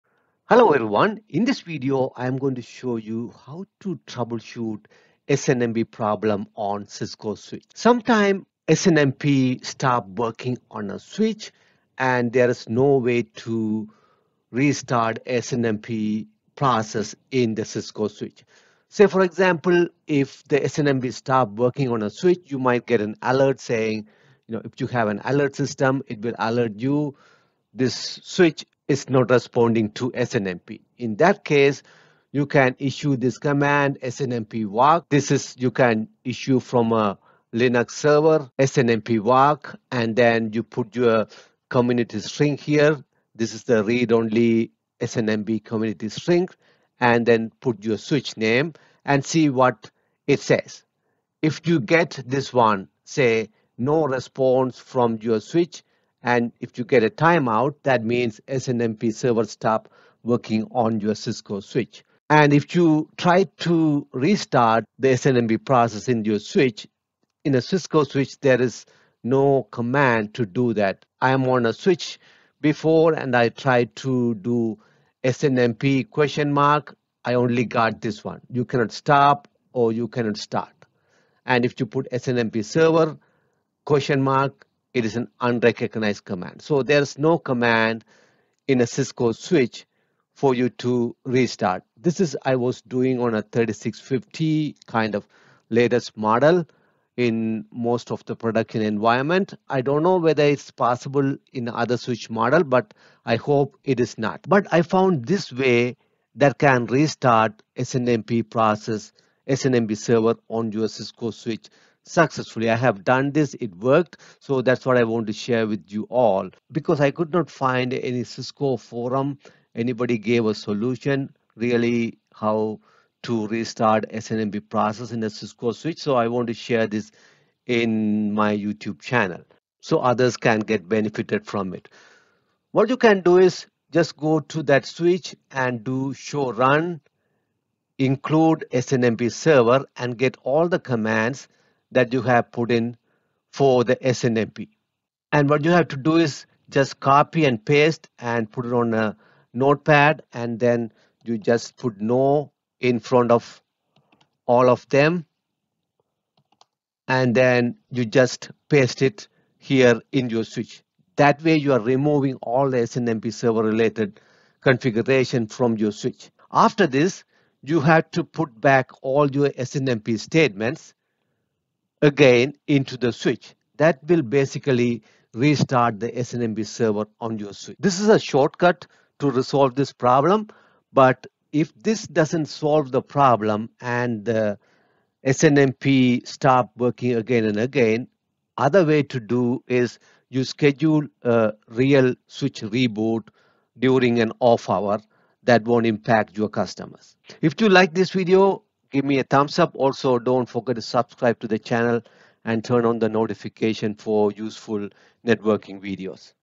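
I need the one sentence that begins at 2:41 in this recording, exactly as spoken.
That way you are removing all the SNMP server related configuration from your switch.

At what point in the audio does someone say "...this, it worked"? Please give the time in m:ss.
1:53.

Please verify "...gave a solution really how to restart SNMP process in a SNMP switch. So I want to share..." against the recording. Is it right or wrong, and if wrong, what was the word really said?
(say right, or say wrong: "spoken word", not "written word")
wrong: "Cisco", not "SNMP".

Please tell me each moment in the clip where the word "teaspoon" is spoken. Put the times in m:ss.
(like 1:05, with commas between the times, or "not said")
not said.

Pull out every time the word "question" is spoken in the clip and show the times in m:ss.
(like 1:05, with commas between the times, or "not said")
1:16, 1:23.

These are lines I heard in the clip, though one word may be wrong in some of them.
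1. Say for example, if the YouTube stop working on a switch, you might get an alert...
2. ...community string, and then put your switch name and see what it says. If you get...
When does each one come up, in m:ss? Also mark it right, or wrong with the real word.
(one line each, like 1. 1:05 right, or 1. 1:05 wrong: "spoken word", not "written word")
1. 0:18 wrong: "SNMP", not "YouTube"
2. 0:45 right.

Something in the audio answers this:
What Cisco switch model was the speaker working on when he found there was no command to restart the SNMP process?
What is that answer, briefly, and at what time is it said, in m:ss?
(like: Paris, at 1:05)
3650, at 1:33.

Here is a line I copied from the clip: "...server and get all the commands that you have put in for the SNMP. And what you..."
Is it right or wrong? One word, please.
right.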